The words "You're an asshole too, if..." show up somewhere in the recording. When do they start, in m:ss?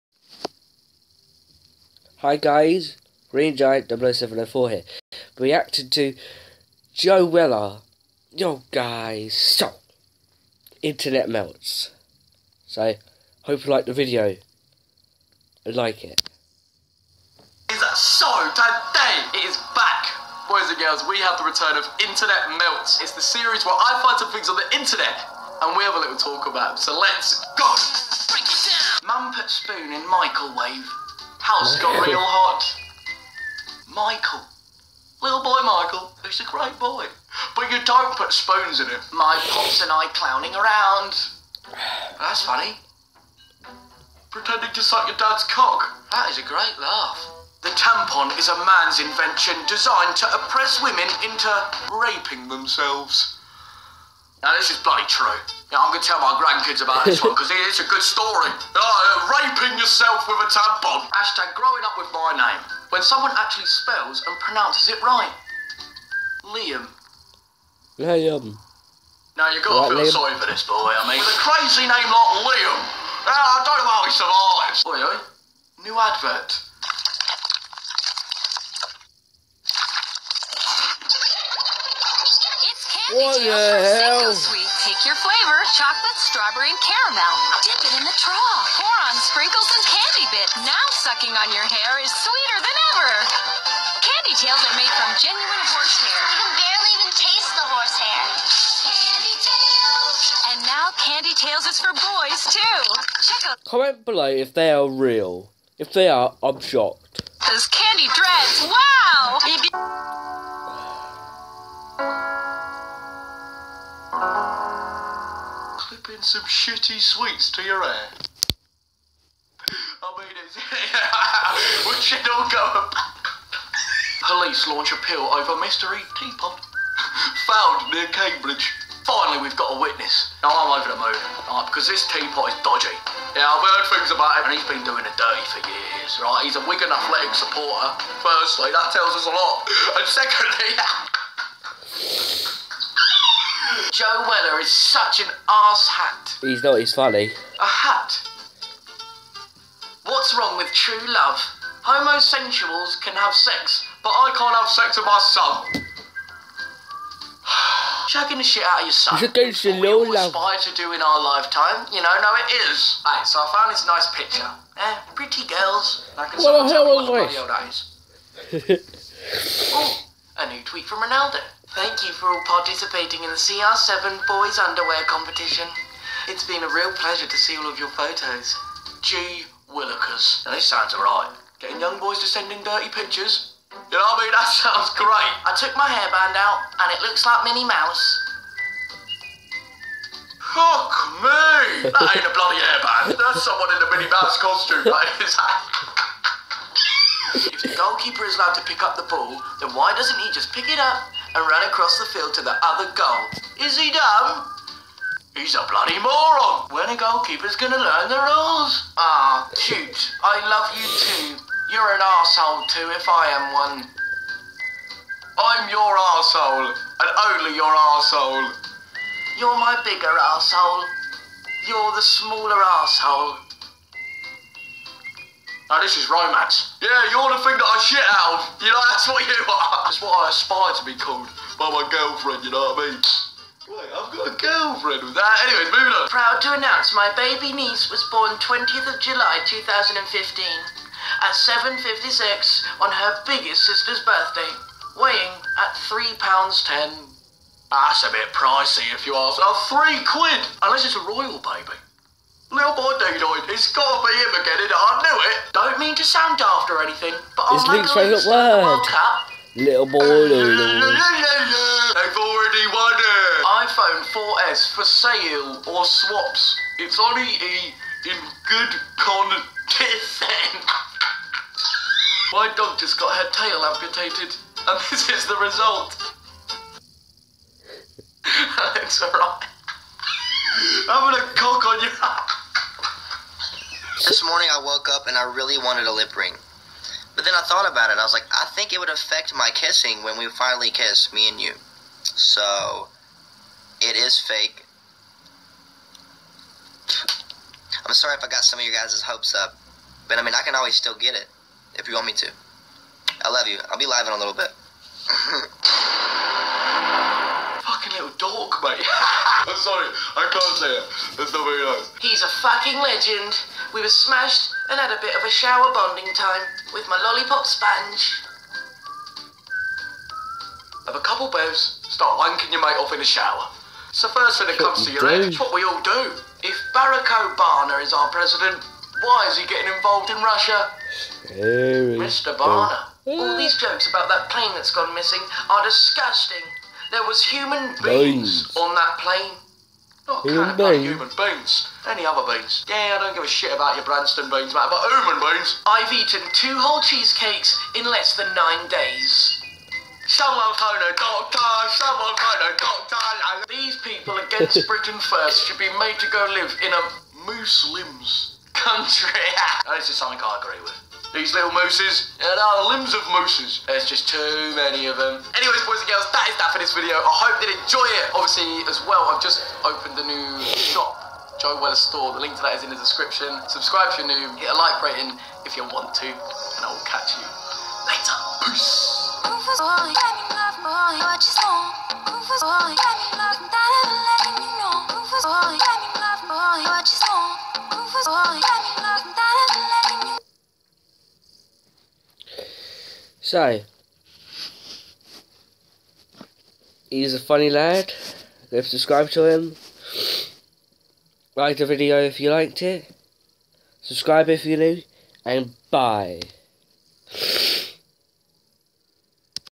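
3:31.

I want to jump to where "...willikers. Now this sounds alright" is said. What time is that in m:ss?
2:59.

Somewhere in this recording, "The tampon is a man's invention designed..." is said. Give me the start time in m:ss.
0:47.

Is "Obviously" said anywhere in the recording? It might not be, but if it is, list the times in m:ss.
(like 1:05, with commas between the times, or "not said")
6:08.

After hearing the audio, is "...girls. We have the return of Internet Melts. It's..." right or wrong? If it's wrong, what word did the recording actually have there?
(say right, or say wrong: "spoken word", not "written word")
right.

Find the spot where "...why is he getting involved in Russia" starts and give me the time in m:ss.
5:29.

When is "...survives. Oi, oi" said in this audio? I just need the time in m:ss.
1:14.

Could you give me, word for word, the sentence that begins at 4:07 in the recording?
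That's a bit pricey if you ask.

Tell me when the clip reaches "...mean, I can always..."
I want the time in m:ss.
5:00.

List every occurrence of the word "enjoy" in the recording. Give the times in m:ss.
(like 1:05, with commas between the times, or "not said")
6:07.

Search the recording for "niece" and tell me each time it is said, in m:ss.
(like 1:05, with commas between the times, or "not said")
3:57.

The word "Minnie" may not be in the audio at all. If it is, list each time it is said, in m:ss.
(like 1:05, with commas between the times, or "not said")
3:07, 3:13.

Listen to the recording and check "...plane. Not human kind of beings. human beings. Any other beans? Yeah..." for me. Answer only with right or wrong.
right.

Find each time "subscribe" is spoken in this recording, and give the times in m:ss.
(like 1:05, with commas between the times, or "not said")
6:13, 6:38, 6:43.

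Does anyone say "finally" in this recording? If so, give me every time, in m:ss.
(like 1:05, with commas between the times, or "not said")
2:09, 4:50.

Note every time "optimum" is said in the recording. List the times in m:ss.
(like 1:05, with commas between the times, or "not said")
not said.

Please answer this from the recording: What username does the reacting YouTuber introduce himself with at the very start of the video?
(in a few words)
Green Giant 00704.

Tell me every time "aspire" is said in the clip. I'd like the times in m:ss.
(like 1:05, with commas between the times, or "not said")
2:40, 3:50.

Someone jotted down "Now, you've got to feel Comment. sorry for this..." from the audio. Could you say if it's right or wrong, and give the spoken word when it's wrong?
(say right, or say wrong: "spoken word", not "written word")
wrong: "Liam", not "Comment".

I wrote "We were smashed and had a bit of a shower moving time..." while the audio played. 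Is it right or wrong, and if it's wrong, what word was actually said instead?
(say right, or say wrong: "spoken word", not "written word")
wrong: "bonding", not "moving".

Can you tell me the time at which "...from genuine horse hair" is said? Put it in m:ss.
1:34.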